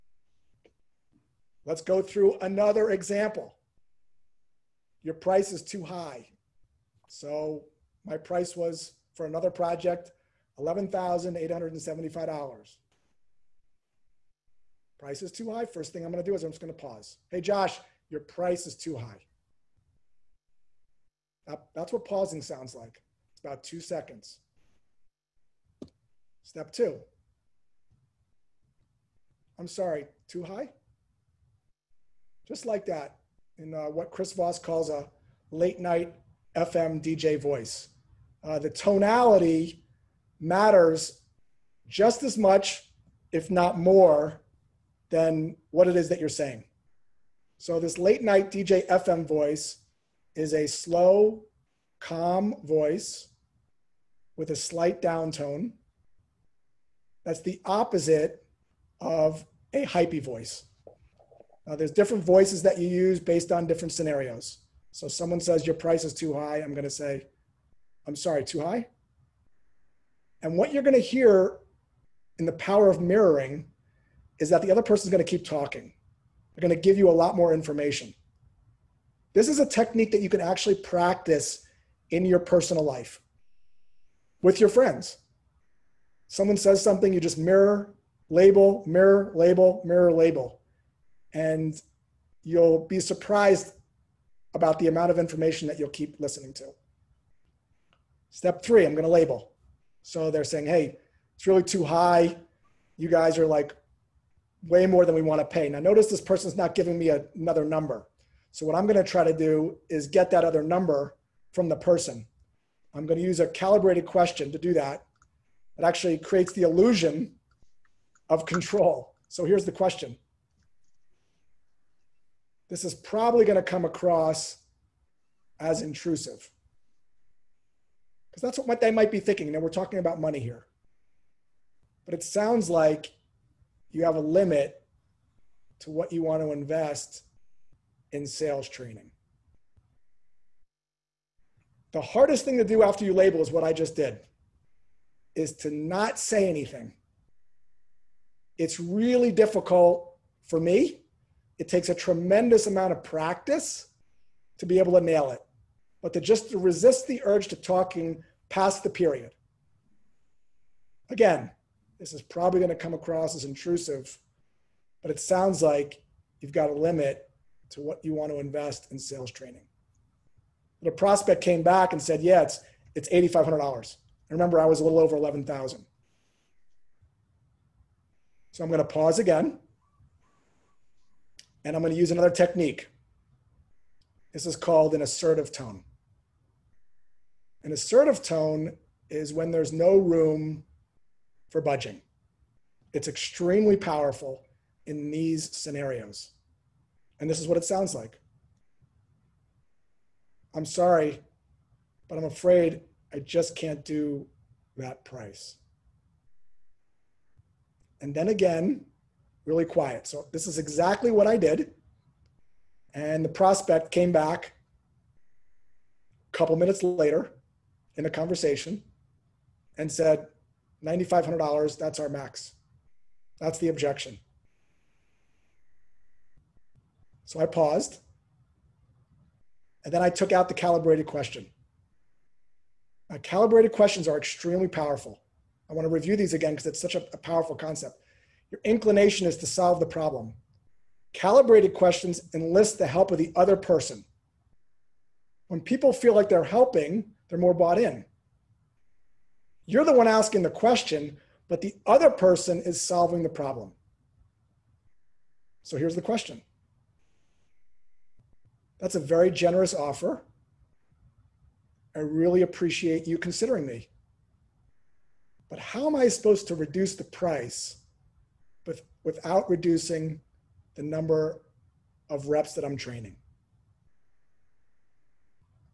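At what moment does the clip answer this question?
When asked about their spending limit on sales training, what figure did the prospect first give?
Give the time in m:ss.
2:53.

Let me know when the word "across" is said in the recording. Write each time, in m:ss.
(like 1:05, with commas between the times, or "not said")
2:03, 2:42.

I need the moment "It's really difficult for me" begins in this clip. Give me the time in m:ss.
2:28.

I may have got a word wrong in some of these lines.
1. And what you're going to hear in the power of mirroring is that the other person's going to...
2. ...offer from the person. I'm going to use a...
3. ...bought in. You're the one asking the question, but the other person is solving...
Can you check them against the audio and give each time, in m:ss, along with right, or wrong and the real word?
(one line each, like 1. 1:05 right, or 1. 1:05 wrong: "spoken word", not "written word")
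1. 1:10 right
2. 1:50 wrong: "number", not "offer"
3. 4:07 right.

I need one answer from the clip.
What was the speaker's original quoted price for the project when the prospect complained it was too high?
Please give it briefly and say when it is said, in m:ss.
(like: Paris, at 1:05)
$11,875, at 0:10.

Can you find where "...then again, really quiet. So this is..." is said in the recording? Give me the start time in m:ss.
3:28.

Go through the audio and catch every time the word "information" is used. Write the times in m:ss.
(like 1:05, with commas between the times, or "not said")
1:17, 1:35.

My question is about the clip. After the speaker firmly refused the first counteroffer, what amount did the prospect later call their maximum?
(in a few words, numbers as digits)
$9,500.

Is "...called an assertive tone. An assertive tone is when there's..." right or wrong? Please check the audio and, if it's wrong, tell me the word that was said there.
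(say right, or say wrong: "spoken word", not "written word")
right.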